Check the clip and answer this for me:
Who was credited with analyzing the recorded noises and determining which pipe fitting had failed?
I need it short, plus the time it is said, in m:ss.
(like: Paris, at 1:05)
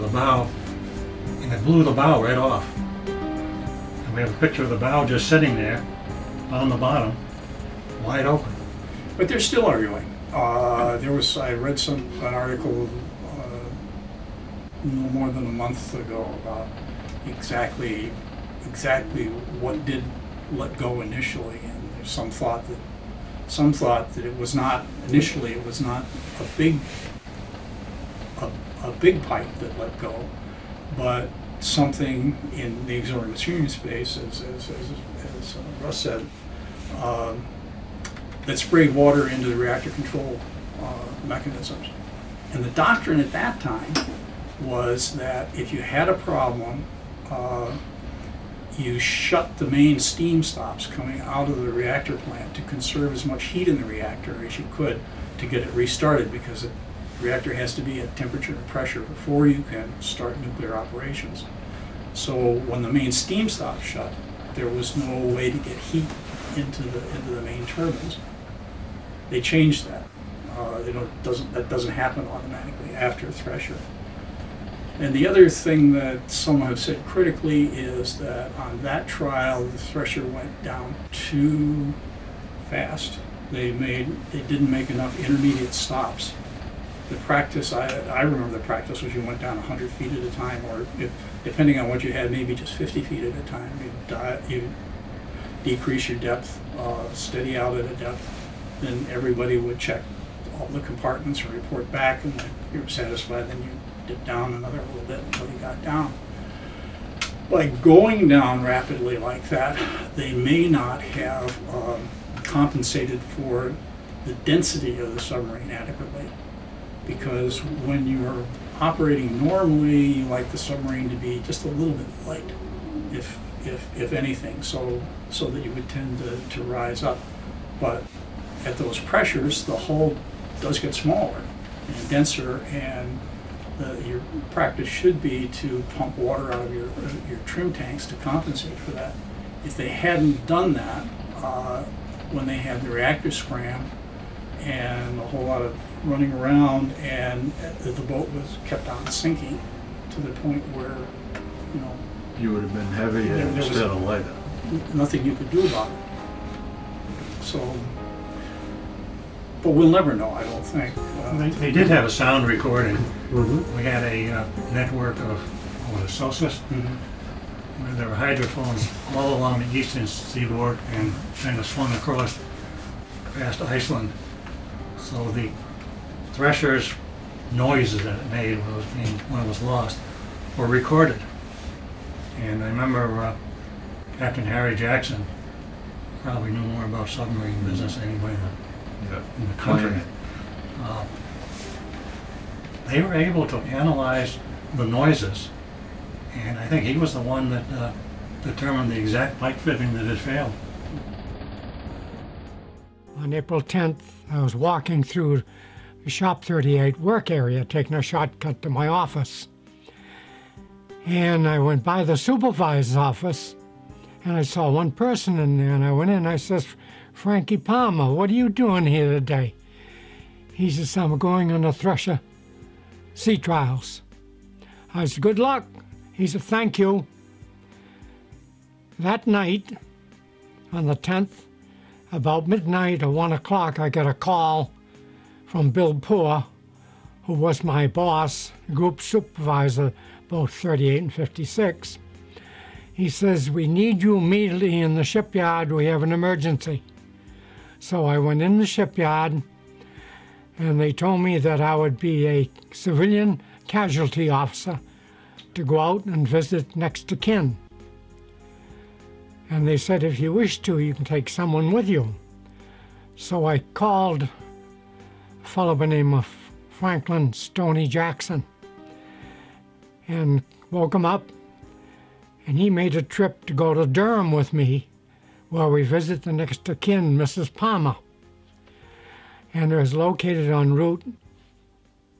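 Captain Harry Jackson, at 3:04.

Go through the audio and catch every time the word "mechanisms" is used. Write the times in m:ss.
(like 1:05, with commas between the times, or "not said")
0:41.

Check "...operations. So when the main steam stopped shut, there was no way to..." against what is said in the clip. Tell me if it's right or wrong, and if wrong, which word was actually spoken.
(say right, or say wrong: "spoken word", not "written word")
right.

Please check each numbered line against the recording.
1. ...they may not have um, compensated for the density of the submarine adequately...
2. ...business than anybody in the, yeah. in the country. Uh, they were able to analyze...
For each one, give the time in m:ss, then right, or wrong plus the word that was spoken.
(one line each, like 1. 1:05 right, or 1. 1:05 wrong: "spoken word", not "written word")
1. 1:50 right
2. 3:07 right.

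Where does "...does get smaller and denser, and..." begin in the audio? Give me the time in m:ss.
2:10.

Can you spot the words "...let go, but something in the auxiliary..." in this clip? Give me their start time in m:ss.
0:29.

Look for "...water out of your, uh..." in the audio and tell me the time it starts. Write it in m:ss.
2:16.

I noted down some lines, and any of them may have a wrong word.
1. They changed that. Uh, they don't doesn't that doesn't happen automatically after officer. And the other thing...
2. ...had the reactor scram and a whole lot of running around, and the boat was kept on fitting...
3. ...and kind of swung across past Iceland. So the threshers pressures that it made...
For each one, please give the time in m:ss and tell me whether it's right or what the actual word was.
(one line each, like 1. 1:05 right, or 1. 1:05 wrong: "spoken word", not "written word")
1. 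1:09 wrong: "thresher", not "officer"
2. 2:22 wrong: "sinking", not "fitting"
3. 2:50 wrong: "noises", not "pressures".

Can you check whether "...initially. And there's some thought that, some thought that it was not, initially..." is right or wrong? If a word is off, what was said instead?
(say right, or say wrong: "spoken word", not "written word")
right.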